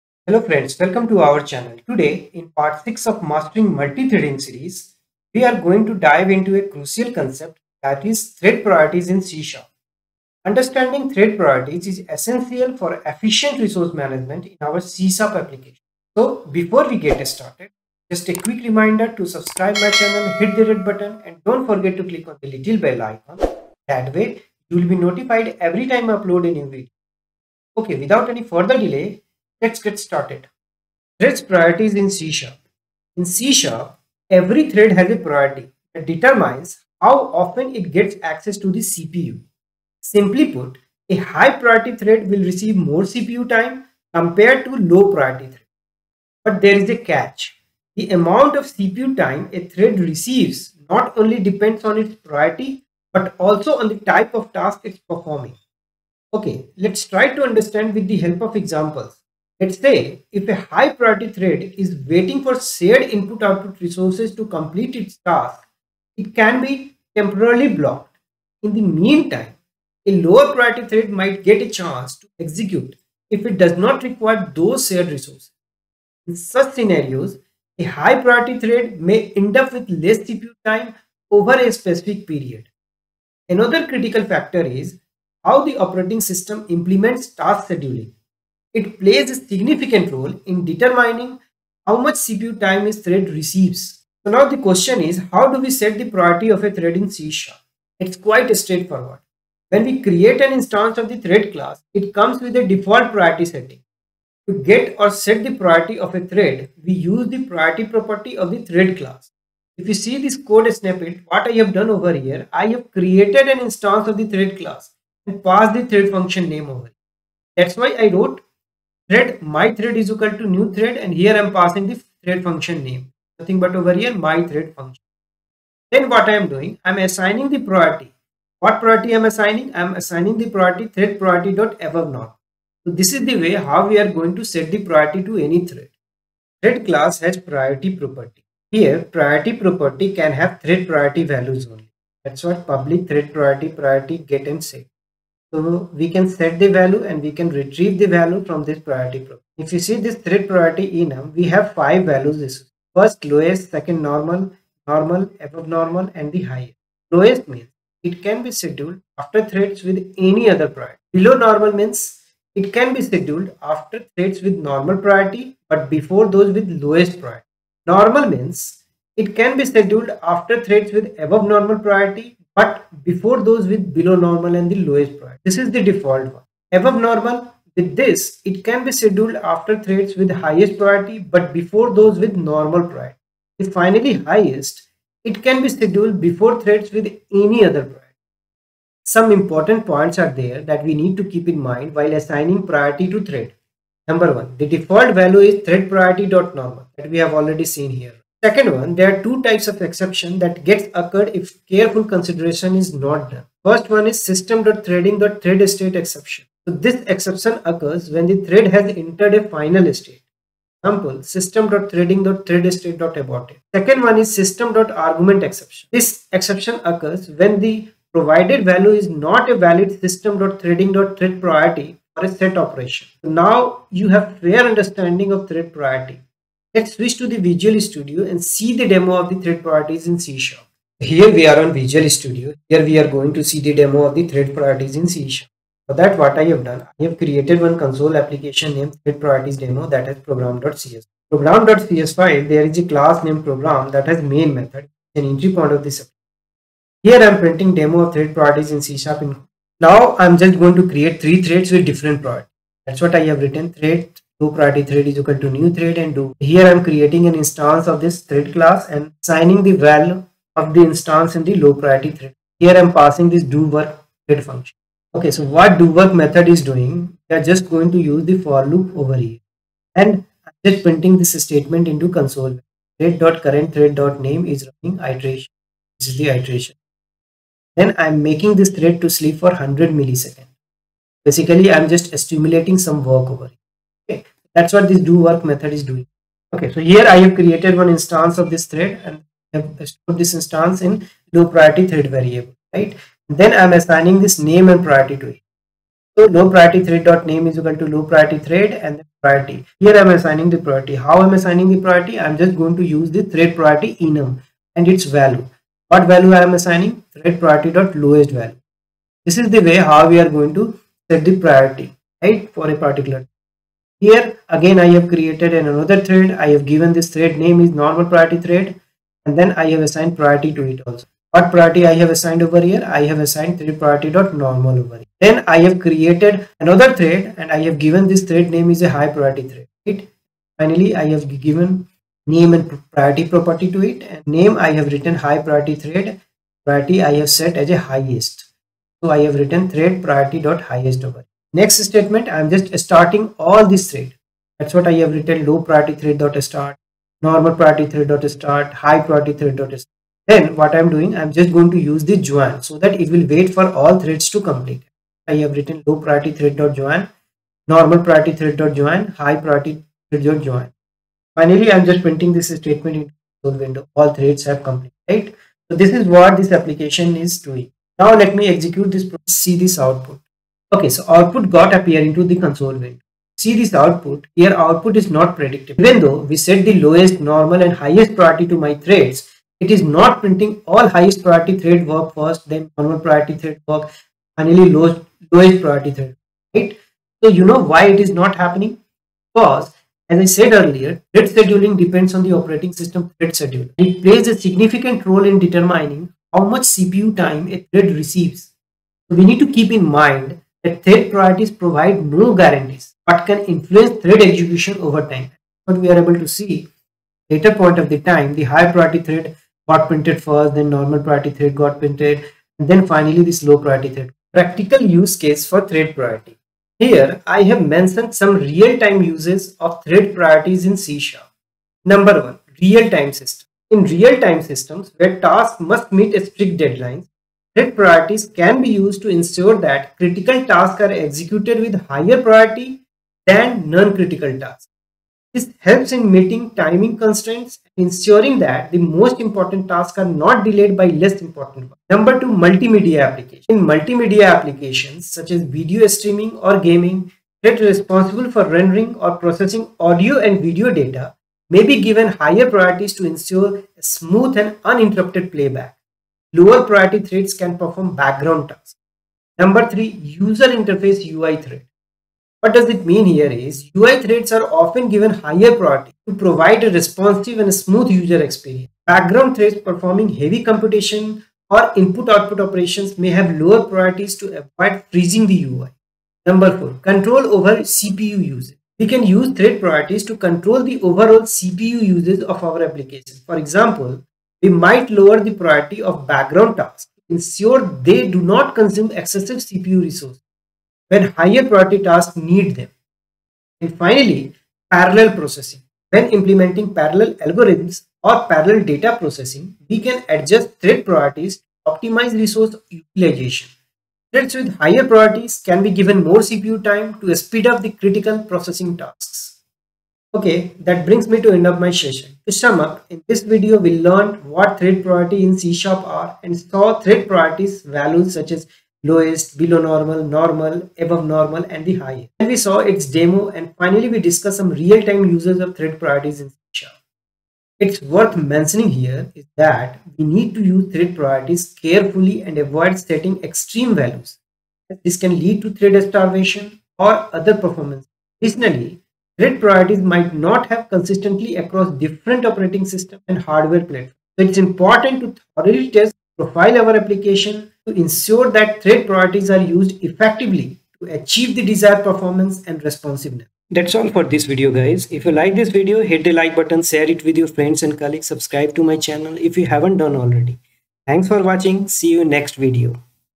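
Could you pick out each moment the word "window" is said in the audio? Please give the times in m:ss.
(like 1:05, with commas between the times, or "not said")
6:03, 6:12.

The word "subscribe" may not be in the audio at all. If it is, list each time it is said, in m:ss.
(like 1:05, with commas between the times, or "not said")
0:19, 9:18.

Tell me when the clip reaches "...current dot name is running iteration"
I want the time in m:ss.
4:33.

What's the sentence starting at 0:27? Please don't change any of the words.
Okay, without any further delay, Let's get started.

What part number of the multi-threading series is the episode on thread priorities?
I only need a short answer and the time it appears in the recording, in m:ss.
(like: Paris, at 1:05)
6, at 0:02.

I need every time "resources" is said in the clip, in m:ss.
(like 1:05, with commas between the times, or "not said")
0:13, 1:03, 1:15, 8:09, 8:22.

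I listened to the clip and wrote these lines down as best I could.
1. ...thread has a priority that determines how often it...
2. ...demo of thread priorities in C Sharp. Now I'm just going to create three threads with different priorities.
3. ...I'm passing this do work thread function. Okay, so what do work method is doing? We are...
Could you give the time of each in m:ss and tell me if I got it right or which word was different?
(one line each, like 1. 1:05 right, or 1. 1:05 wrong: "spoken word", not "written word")
1. 0:34 right
2. 4:07 right
3. 4:22 right.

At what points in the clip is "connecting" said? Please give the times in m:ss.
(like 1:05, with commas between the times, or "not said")
not said.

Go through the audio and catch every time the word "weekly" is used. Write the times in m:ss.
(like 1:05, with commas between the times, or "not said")
not said.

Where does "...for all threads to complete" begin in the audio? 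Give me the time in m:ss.
5:53.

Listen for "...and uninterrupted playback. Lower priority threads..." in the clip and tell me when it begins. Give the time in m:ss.
7:34.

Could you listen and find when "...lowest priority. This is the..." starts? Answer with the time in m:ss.
2:54.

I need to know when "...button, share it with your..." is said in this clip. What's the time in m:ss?
9:16.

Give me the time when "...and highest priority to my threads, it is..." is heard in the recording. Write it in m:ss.
6:17.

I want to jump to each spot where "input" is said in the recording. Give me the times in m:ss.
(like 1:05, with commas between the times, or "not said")
1:03, 7:51.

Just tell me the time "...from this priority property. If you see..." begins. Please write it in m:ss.
2:28.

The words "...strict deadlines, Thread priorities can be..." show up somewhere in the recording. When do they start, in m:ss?
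7:06.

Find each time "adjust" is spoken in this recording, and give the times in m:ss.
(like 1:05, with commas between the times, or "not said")
8:20.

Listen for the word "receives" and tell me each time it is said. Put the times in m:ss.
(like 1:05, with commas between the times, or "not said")
0:42, 0:49, 1:33, 6:37.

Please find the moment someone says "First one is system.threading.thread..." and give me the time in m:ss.
3:23.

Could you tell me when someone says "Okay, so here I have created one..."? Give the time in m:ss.
4:46.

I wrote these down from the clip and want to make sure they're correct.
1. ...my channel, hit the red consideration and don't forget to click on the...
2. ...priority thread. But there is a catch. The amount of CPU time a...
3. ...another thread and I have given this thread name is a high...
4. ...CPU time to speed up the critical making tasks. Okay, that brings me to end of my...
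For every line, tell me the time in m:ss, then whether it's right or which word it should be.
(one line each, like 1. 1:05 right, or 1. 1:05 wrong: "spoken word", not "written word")
1. 0:19 wrong: "button", not "consideration"
2. 0:45 right
3. 5:26 right
4. 8:26 wrong: "processing", not "making".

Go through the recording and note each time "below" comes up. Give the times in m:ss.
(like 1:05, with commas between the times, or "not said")
2:41, 2:53, 8:39.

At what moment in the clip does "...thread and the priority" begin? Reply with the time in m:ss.
4:58.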